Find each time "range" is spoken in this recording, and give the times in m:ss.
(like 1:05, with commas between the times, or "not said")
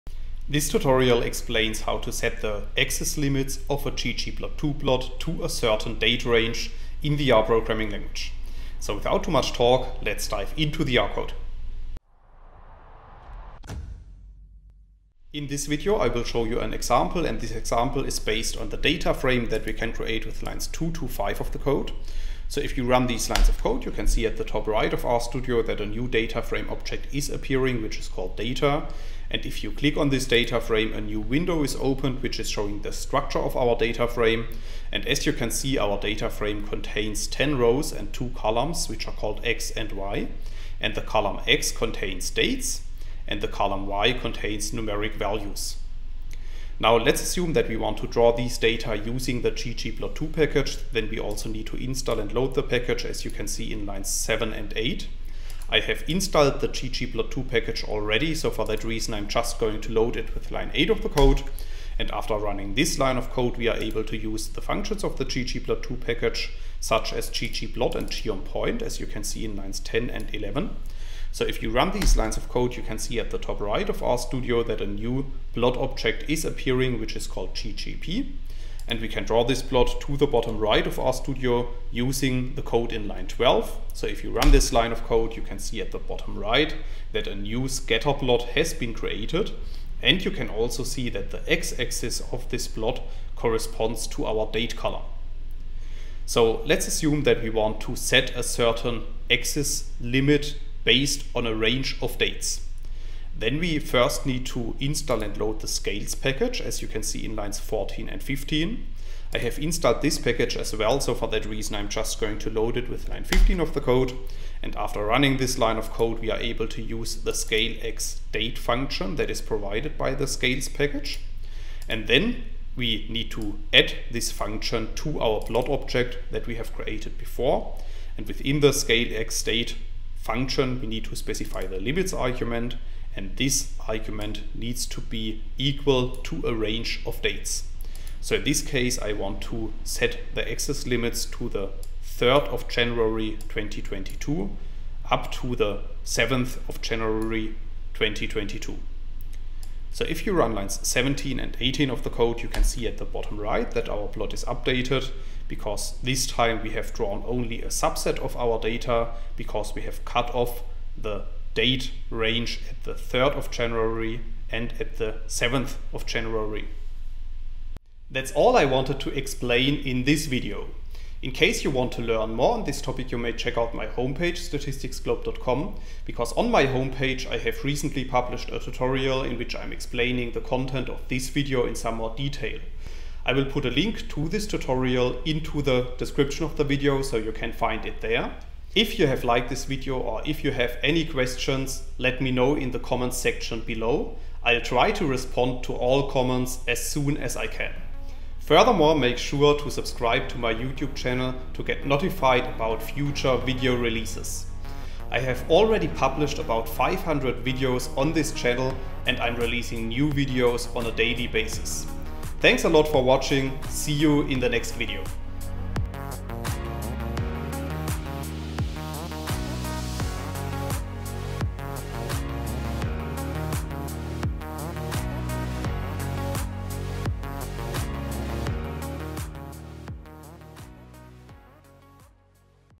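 0:06, 1:41, 2:16, 2:42.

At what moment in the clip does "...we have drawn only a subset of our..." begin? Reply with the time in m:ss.
2:36.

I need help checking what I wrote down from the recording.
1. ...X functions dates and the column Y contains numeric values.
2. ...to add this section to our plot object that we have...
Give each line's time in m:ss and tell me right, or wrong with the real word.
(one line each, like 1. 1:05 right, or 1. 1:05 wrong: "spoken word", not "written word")
1. 0:41 wrong: "contains", not "functions"
2. 2:03 wrong: "function", not "section".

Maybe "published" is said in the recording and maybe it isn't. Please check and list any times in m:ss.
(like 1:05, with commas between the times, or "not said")
2:58, 3:25.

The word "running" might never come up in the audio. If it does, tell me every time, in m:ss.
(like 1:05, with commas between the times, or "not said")
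1:02, 1:55.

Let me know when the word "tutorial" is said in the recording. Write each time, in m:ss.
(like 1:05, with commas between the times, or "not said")
0:00, 2:58, 3:04.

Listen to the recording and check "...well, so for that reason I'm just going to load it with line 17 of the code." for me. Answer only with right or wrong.
wrong.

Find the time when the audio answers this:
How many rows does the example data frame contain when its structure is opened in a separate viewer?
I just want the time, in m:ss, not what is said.
0:37.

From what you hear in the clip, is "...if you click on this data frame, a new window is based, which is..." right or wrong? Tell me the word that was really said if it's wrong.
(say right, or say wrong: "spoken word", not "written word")
wrong: "opened", not "based".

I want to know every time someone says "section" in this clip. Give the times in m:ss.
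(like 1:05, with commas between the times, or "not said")
3:13.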